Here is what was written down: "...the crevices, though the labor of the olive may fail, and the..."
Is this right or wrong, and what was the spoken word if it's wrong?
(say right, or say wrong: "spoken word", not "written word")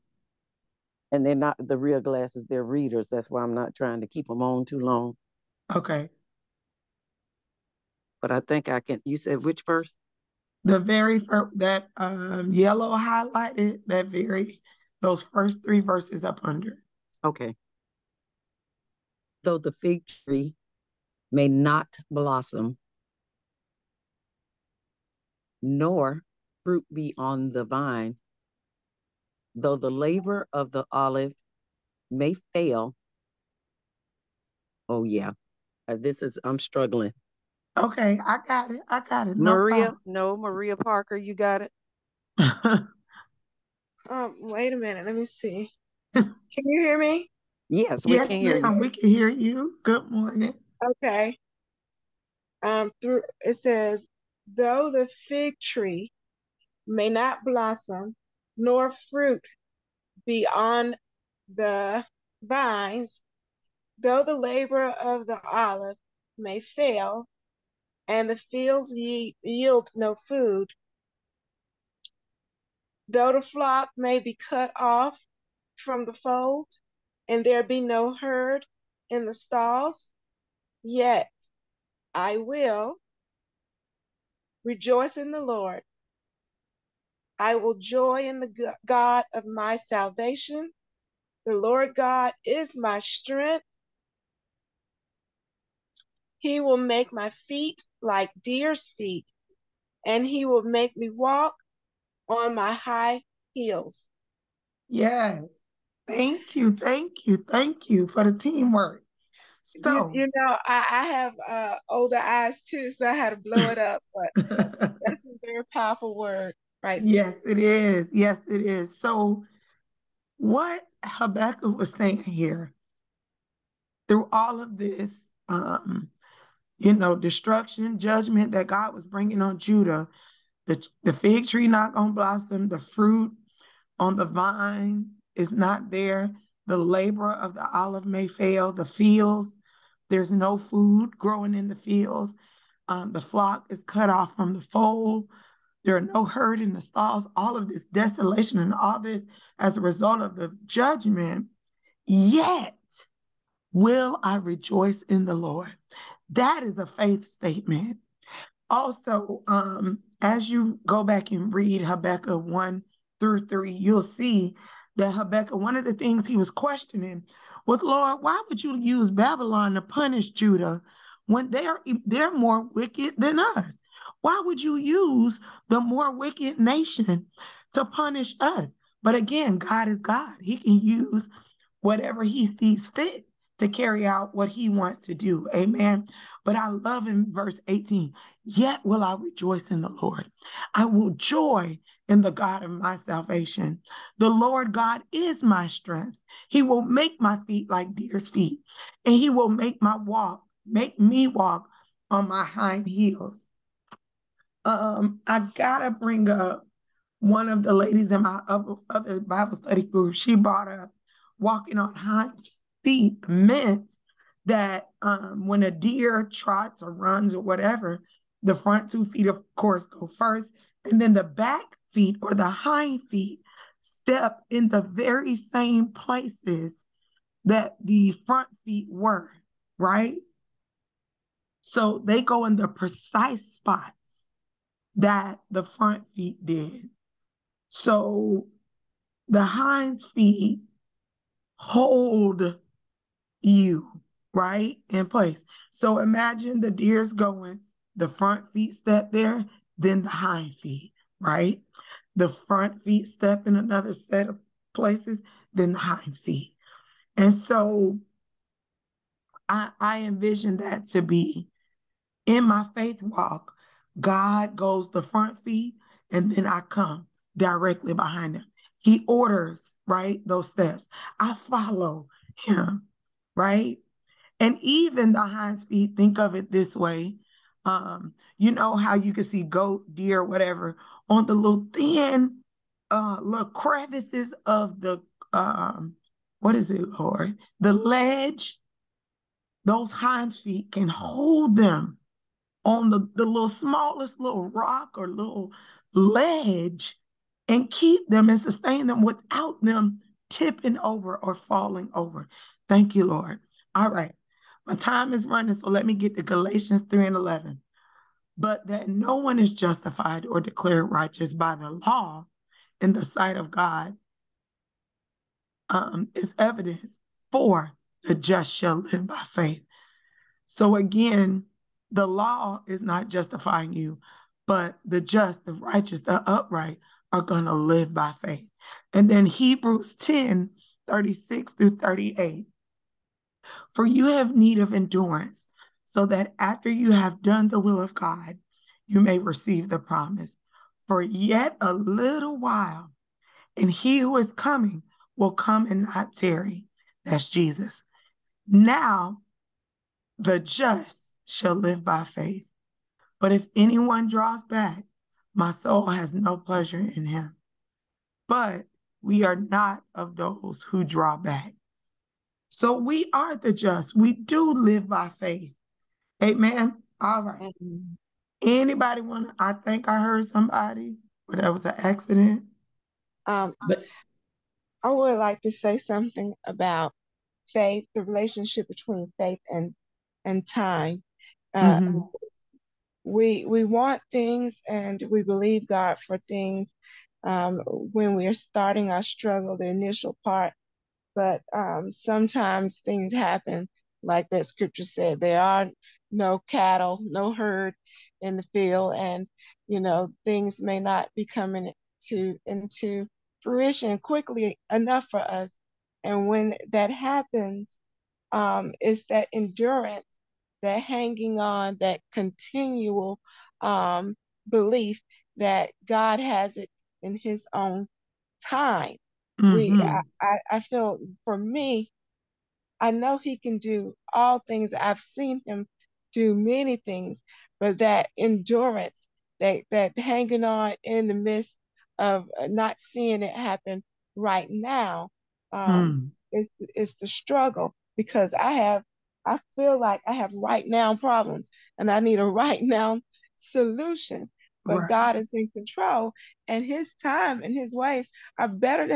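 wrong: "vines", not "crevices".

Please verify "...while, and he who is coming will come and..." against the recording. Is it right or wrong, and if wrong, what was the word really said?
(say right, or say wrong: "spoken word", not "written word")
right.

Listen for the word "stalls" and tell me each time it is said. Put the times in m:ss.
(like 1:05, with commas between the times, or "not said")
1:19, 2:26.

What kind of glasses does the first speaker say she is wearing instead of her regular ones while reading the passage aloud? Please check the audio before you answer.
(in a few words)
Readers.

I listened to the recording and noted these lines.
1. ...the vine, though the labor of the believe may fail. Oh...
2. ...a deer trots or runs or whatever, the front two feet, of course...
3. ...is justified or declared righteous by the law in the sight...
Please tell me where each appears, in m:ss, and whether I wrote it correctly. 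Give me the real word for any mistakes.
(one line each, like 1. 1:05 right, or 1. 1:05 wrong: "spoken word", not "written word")
1. 0:27 wrong: "olive", not "believe"
2. 3:35 right
3. 5:09 right.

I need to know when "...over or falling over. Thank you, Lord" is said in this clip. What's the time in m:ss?
5:00.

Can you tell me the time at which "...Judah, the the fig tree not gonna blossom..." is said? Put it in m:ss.
2:09.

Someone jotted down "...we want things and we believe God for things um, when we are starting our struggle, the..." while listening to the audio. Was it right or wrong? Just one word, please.
right.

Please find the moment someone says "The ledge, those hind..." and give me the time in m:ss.
4:47.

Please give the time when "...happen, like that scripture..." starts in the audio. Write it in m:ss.
6:33.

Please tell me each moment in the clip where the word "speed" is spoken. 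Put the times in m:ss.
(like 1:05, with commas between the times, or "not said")
not said.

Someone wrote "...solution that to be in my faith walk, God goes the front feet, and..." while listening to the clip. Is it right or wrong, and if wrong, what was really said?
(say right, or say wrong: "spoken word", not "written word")
wrong: "envision", not "solution".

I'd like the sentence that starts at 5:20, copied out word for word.
So again, the law is not justifying you, but the just, the righteous, the upright are going to live by faith.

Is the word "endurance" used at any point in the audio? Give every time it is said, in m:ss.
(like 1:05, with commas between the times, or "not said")
5:34, 6:49, 7:08.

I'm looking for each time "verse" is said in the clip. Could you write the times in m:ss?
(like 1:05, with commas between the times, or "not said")
0:09, 0:15, 3:07.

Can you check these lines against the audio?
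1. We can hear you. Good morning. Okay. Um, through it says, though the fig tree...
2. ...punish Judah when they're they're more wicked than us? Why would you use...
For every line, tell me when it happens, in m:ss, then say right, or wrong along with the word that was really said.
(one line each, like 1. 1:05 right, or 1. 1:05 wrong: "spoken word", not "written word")
1. 0:48 right
2. 2:49 right.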